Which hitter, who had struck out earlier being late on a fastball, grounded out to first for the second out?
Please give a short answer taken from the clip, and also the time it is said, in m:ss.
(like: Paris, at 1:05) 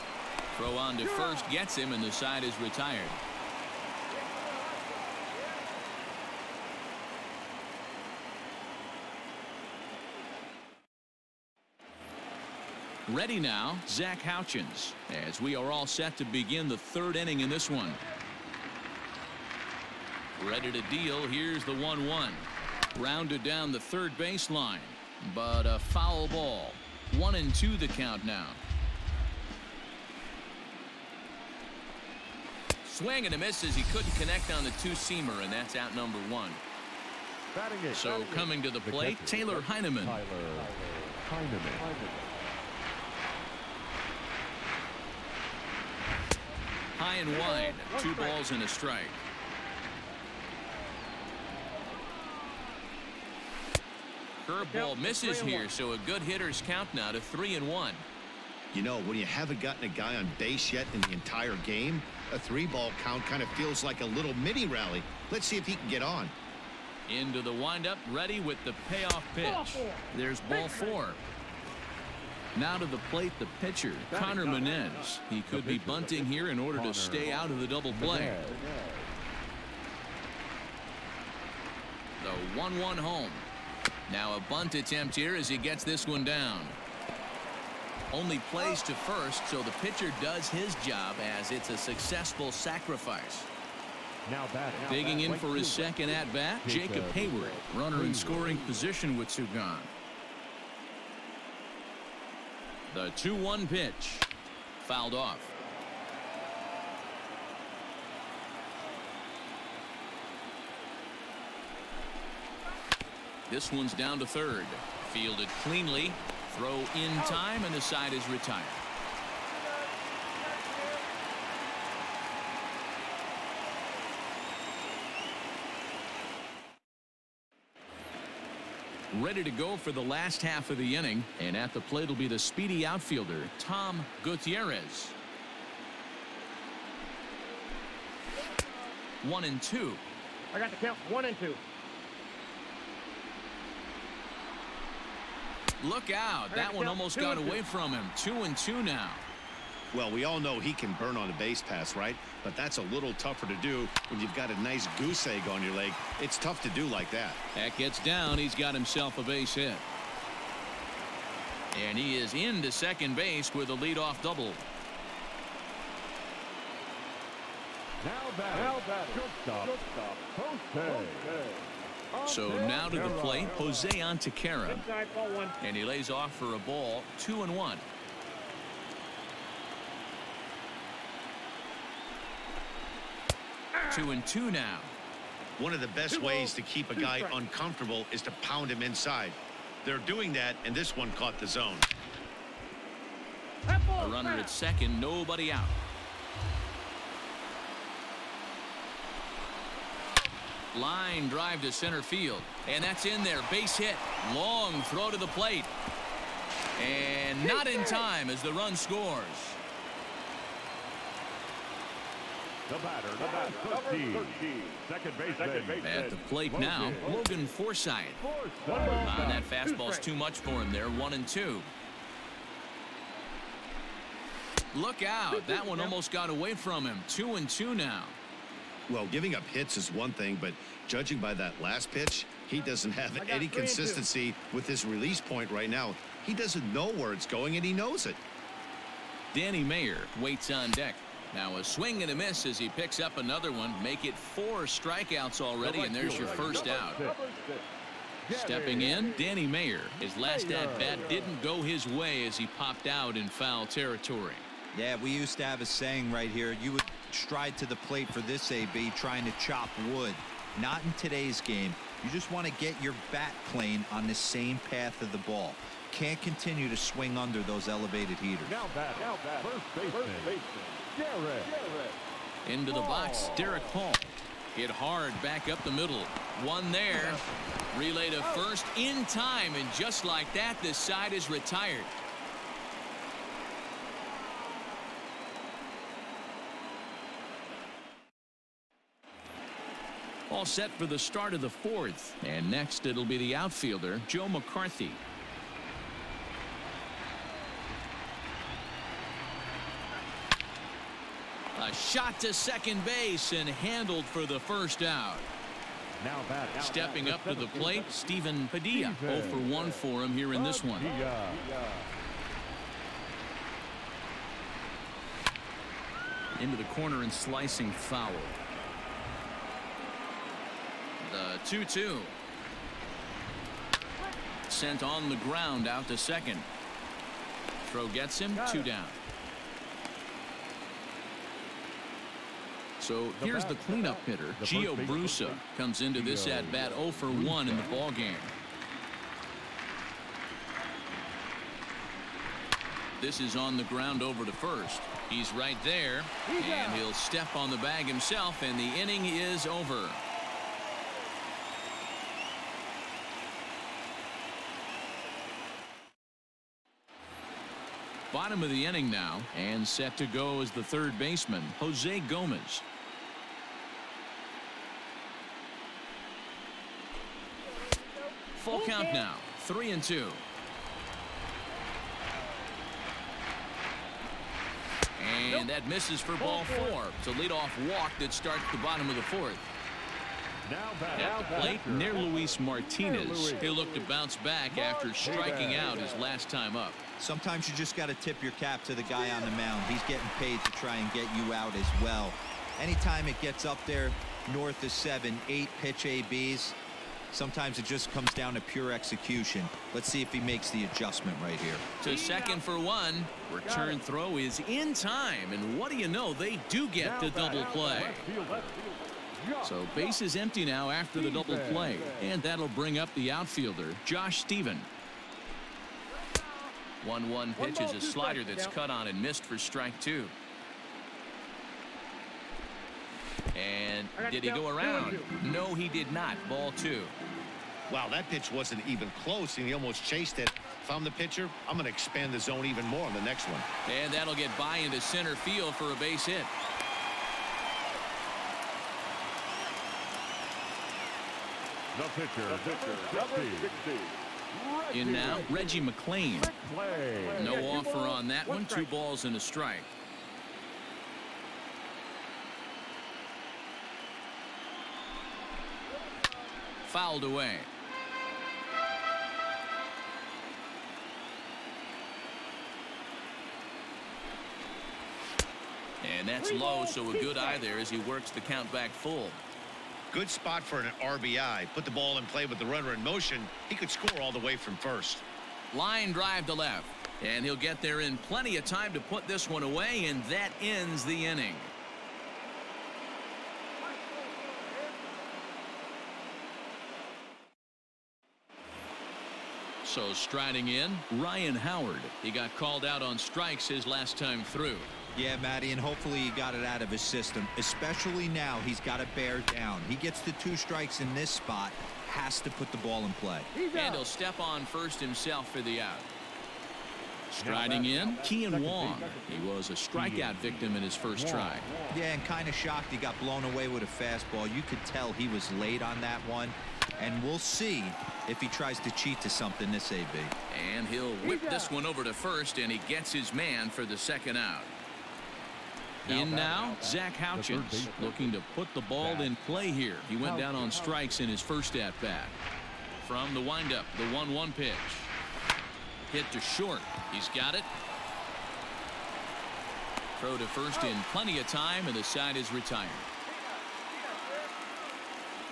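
Kean Wong, at 8:28.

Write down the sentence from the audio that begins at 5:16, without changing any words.
Into the corner and slicing foul.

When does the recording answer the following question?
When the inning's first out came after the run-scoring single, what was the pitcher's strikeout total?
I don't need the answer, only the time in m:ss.
4:04.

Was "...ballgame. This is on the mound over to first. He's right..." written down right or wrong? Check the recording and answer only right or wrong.
wrong.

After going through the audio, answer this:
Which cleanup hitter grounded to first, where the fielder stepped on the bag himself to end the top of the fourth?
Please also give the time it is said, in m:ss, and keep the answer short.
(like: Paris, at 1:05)
Gio Brusa, at 5:34.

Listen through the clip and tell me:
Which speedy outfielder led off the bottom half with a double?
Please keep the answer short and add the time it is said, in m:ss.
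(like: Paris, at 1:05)
Tom Gutierrez, at 2:13.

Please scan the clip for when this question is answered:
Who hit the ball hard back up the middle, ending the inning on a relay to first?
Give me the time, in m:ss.
4:33.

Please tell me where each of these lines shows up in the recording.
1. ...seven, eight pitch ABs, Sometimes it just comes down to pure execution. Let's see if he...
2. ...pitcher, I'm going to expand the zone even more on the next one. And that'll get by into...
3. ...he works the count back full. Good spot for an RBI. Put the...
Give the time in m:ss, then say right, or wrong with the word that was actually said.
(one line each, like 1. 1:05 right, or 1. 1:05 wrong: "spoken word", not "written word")
1. 6:34 right
2. 7:10 right
3. 7:47 right.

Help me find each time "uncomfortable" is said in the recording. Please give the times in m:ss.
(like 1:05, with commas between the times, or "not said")
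3:07.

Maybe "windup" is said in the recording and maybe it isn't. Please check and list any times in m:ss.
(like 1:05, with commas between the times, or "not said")
1:07, 8:53.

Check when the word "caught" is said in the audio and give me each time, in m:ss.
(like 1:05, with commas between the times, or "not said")
3:11.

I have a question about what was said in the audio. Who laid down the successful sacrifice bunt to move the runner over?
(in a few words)
Connor Menez.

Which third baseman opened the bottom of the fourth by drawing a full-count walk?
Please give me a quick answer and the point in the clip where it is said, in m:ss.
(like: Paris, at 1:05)
Jose Gomez, at 6:01.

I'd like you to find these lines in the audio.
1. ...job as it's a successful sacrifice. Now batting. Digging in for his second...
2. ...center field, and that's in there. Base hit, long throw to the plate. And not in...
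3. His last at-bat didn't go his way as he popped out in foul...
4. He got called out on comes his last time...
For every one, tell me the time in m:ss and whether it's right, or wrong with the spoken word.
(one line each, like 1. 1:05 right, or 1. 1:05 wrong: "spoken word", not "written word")
1. 1:30 right
2. 3:21 right
3. 4:09 right
4. 8:12 wrong: "strikes", not "comes".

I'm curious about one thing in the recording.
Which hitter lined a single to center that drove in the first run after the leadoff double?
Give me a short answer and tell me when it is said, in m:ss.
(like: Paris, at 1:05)
Jose Antequera, at 2:53.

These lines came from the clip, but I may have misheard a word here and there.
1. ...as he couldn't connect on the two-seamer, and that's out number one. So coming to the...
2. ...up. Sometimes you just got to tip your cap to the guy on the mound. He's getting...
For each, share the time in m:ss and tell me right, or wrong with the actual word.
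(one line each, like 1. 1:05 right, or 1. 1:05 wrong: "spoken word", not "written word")
1. 0:33 right
2. 6:26 right.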